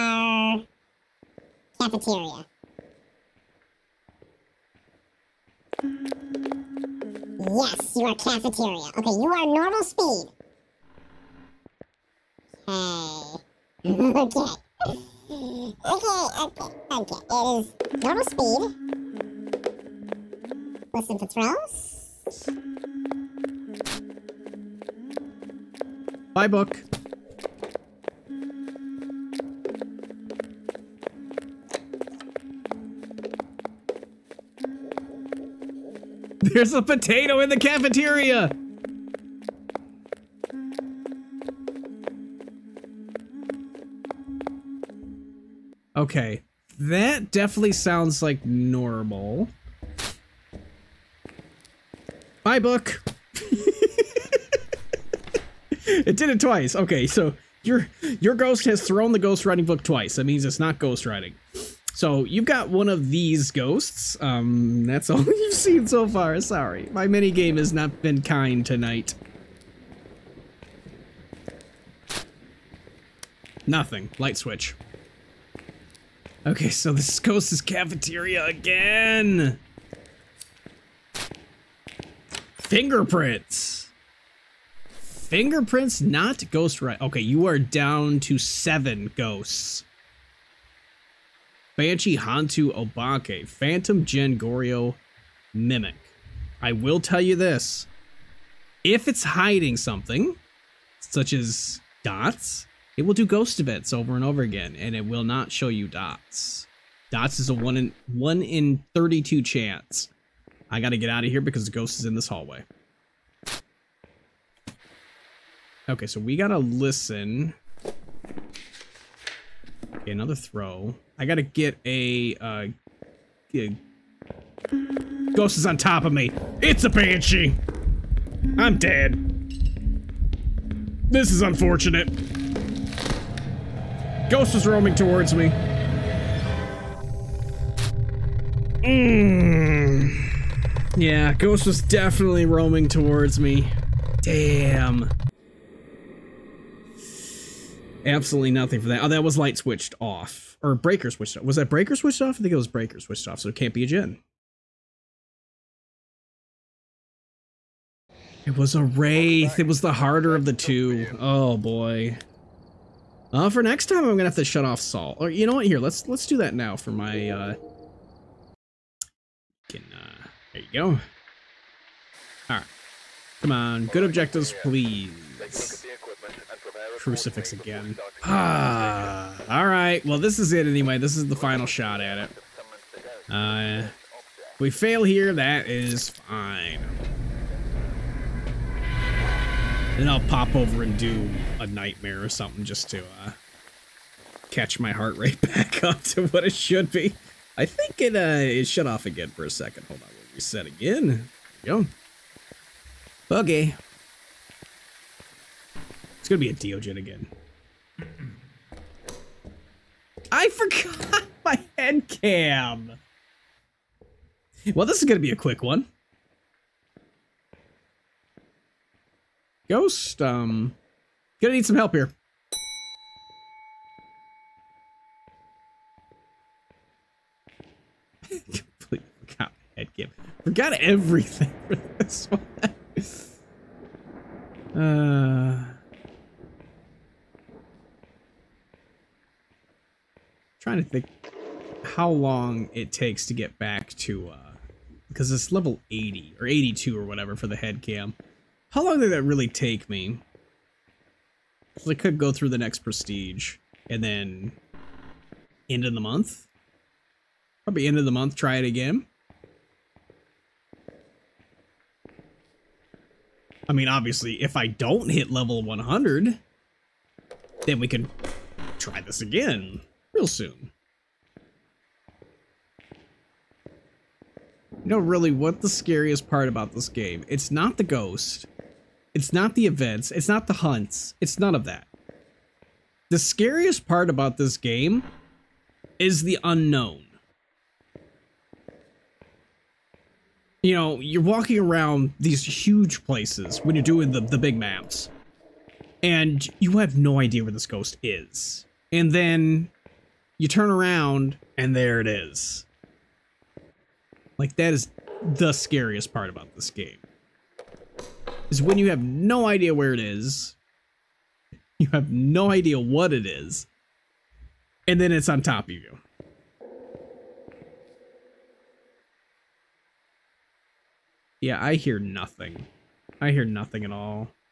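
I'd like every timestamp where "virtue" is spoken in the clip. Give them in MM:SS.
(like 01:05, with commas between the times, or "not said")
not said.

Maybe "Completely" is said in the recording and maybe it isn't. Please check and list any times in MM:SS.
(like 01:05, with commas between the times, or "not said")
03:48.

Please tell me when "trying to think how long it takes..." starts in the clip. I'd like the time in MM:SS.
04:00.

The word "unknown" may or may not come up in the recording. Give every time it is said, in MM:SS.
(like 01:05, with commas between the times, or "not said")
04:46.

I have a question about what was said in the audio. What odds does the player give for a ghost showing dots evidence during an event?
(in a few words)
1 in 32.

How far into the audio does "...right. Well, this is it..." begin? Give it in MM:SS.
02:59.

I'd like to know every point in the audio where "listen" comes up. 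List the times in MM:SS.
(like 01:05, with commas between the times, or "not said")
00:20, 01:56.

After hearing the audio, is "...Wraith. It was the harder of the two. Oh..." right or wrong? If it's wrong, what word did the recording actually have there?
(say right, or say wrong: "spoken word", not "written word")
right.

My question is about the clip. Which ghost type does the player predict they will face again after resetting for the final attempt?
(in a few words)
Deogen.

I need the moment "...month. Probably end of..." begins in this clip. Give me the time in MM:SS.
04:15.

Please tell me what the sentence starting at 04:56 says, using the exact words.
And you have no idea where this ghost is.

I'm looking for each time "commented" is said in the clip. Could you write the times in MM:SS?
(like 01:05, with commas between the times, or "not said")
not said.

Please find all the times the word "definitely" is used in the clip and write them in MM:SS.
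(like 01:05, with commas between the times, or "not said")
00:47, 02:21.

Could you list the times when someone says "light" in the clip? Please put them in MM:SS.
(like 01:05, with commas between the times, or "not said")
01:14, 02:29.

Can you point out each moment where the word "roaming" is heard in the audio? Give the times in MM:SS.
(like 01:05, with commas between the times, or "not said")
02:14, 02:22.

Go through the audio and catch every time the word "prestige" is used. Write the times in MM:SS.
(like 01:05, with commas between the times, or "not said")
04:12.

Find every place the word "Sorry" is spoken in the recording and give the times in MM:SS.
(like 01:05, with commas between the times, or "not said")
01:06.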